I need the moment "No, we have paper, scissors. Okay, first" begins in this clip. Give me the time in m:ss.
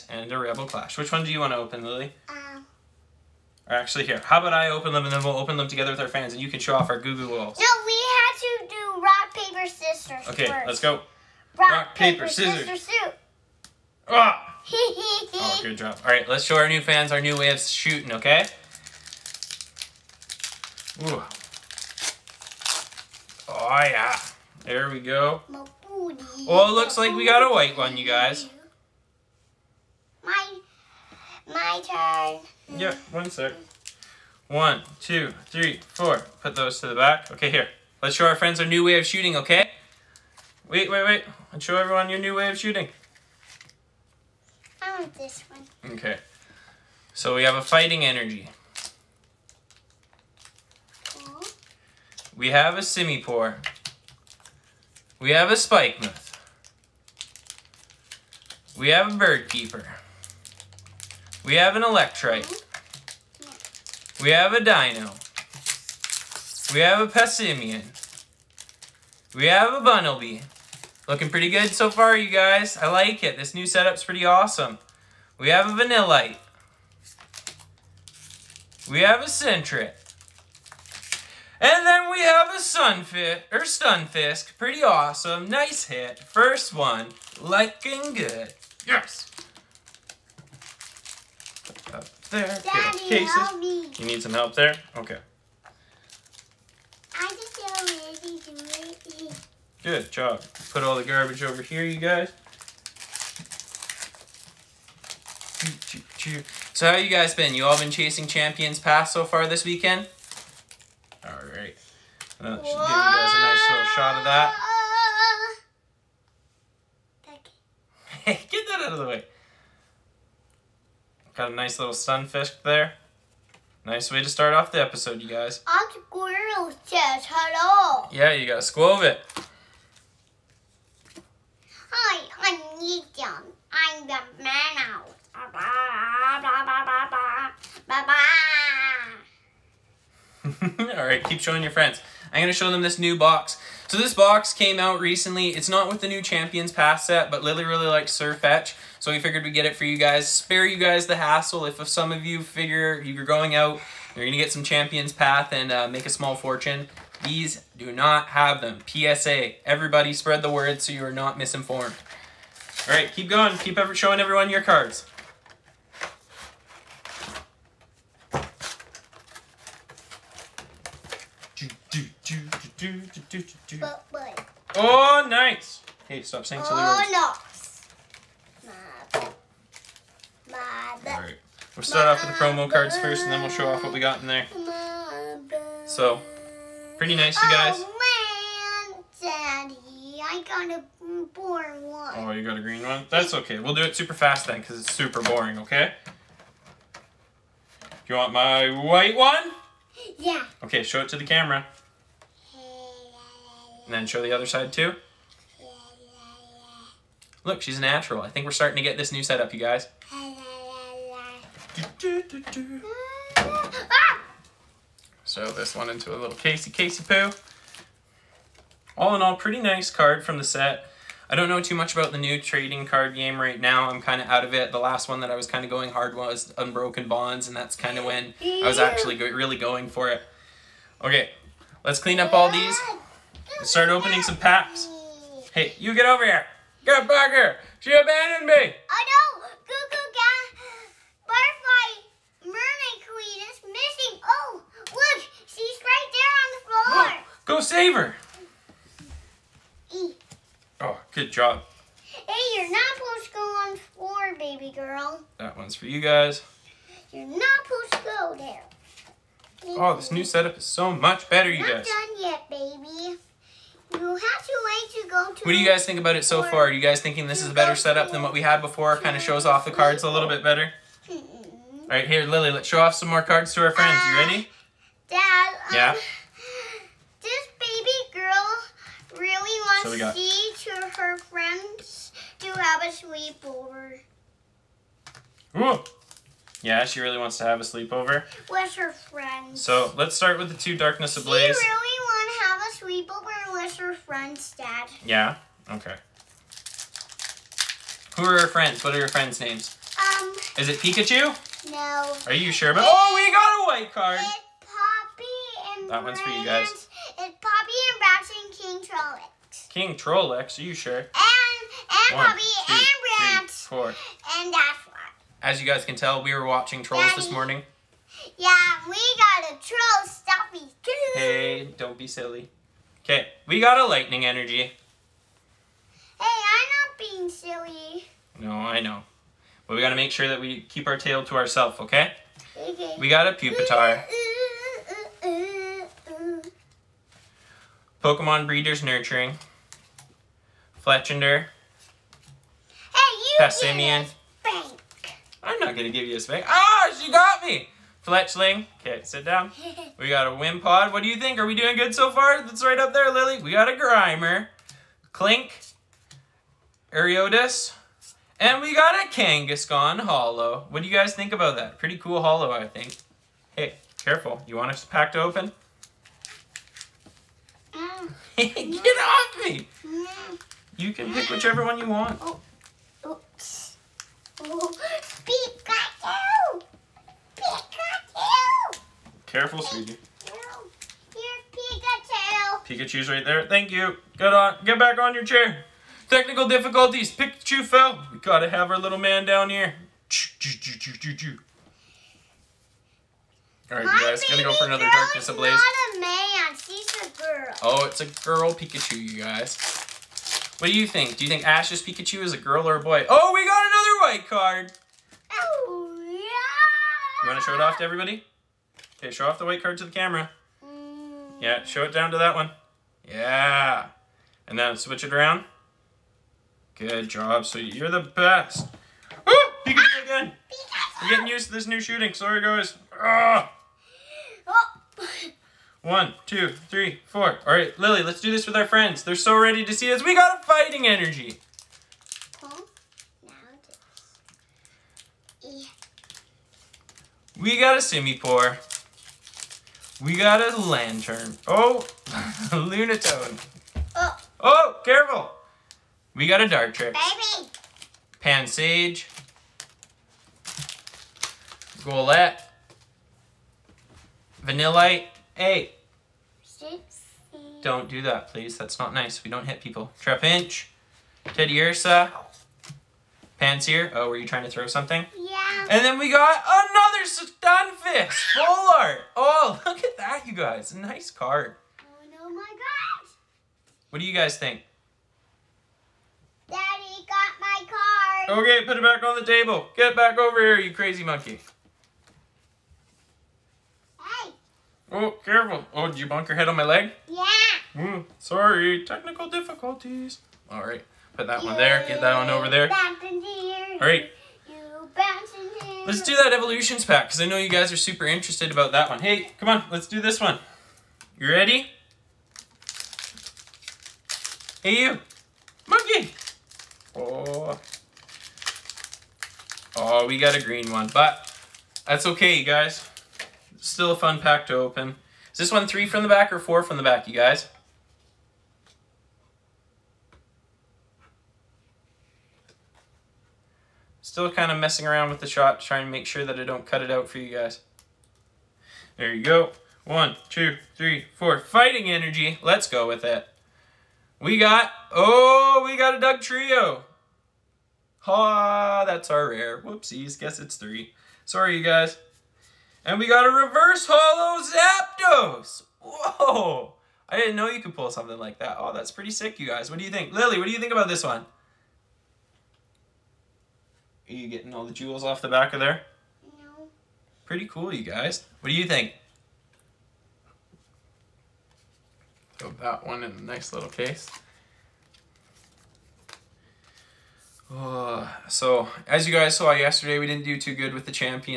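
0:07.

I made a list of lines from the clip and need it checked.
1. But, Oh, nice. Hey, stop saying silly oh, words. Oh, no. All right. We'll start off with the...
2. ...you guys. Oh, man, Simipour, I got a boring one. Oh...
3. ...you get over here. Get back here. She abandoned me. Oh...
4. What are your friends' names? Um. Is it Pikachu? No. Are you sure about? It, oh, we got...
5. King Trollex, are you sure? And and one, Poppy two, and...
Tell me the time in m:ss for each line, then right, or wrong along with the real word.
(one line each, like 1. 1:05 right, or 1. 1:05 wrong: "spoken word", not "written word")
1. 2:53 right
2. 3:07 wrong: "Daddy", not "Simipour"
3. 3:55 right
4. 4:58 right
5. 5:09 right.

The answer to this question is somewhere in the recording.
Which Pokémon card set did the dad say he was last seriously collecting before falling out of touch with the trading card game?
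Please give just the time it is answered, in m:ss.
3:46.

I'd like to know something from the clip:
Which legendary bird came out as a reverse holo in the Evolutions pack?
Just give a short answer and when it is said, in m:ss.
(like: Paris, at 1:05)
Zapdos, at 9:03.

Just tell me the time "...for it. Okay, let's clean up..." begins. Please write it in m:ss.
3:49.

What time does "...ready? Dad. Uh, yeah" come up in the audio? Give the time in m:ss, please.
4:34.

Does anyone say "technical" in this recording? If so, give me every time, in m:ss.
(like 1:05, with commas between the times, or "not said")
6:26, 8:08.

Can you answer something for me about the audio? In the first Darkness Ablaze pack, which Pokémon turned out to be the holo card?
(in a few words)
Kangaskhan.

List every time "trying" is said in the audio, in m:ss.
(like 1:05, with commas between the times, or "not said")
7:44, 8:45.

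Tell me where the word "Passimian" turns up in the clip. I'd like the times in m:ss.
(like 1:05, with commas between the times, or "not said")
1:07, 5:43.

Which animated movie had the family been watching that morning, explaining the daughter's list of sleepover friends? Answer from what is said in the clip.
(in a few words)
Trolls.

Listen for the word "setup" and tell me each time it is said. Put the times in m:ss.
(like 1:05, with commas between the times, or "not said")
1:13, 3:29, 4:20, 4:27.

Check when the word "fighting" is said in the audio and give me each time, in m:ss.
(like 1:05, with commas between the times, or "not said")
0:47, 7:10, 8:51.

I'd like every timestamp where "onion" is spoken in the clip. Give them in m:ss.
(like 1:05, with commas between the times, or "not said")
not said.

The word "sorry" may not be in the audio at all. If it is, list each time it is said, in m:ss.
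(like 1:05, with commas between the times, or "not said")
7:02, 8:08, 9:01.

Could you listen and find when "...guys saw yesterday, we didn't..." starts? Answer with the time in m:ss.
9:29.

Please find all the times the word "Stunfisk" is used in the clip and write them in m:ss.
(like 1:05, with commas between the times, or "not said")
1:23, 7:47.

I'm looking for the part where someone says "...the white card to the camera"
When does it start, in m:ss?
6:49.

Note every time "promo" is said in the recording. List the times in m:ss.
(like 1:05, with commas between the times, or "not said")
3:02.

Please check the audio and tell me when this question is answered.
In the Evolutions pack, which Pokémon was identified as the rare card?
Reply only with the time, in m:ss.
8:56.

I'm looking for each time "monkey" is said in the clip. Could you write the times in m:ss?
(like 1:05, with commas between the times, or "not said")
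8:01, 8:25.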